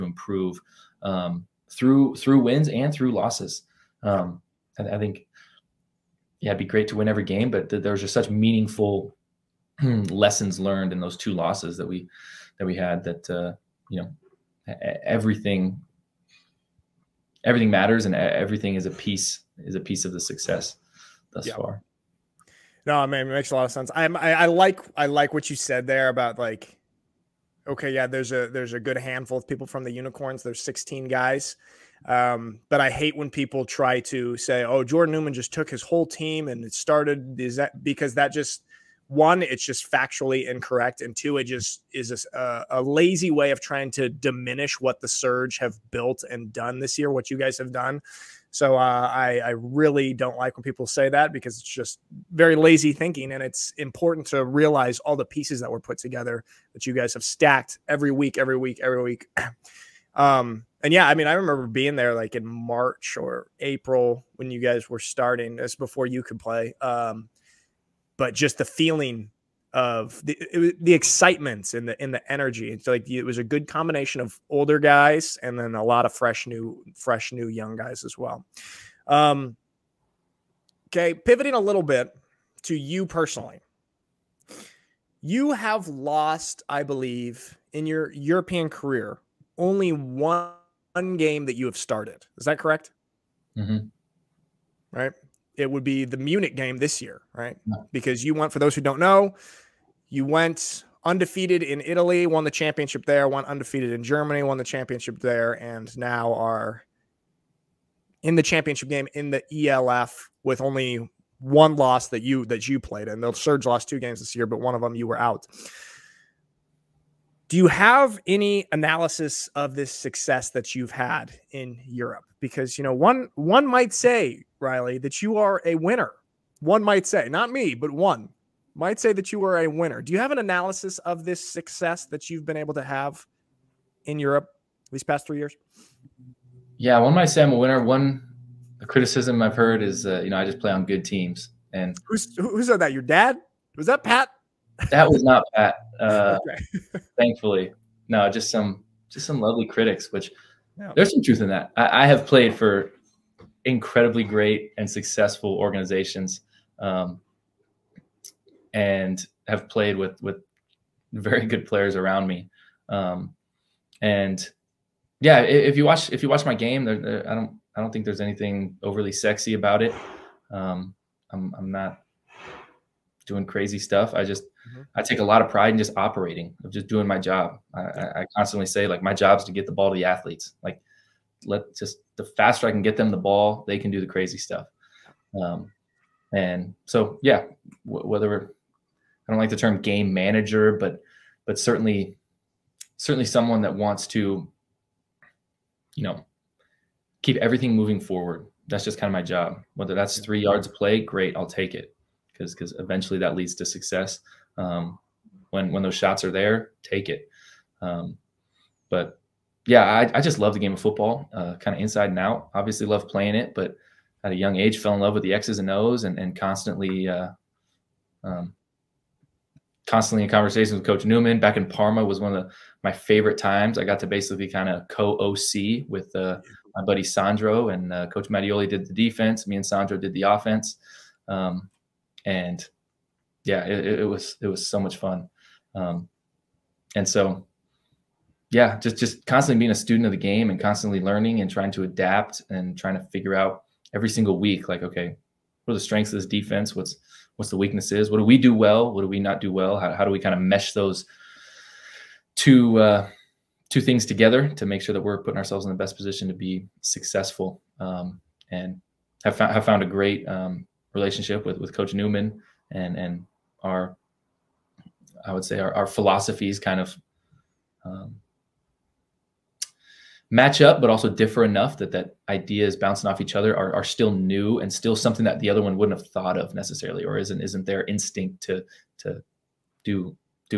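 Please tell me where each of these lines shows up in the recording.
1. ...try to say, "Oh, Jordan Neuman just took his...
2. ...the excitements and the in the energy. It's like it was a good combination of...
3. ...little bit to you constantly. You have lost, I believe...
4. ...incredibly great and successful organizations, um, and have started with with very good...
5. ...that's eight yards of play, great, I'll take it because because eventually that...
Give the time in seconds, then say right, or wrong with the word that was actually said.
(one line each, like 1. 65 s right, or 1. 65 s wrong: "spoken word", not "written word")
1. 33 s right
2. 70 s right
3. 81 s wrong: "personally", not "constantly"
4. 153 s wrong: "played", not "started"
5. 199 s wrong: "three", not "eight".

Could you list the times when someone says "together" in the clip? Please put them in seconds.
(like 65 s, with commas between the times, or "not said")
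55 s, 254 s.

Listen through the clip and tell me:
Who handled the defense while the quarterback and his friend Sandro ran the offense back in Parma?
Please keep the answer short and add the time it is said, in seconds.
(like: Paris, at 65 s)
Coach Mattioli, at 228 s.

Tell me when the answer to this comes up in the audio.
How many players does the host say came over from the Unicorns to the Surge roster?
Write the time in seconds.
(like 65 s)
30 s.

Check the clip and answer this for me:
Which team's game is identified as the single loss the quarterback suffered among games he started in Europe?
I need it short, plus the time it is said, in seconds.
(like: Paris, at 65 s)
Munich, at 96 s.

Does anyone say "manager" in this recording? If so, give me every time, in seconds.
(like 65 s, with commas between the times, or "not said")
190 s.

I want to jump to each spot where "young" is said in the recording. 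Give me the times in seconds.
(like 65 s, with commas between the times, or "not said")
77 s, 214 s.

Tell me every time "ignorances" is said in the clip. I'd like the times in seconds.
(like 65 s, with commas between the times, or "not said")
not said.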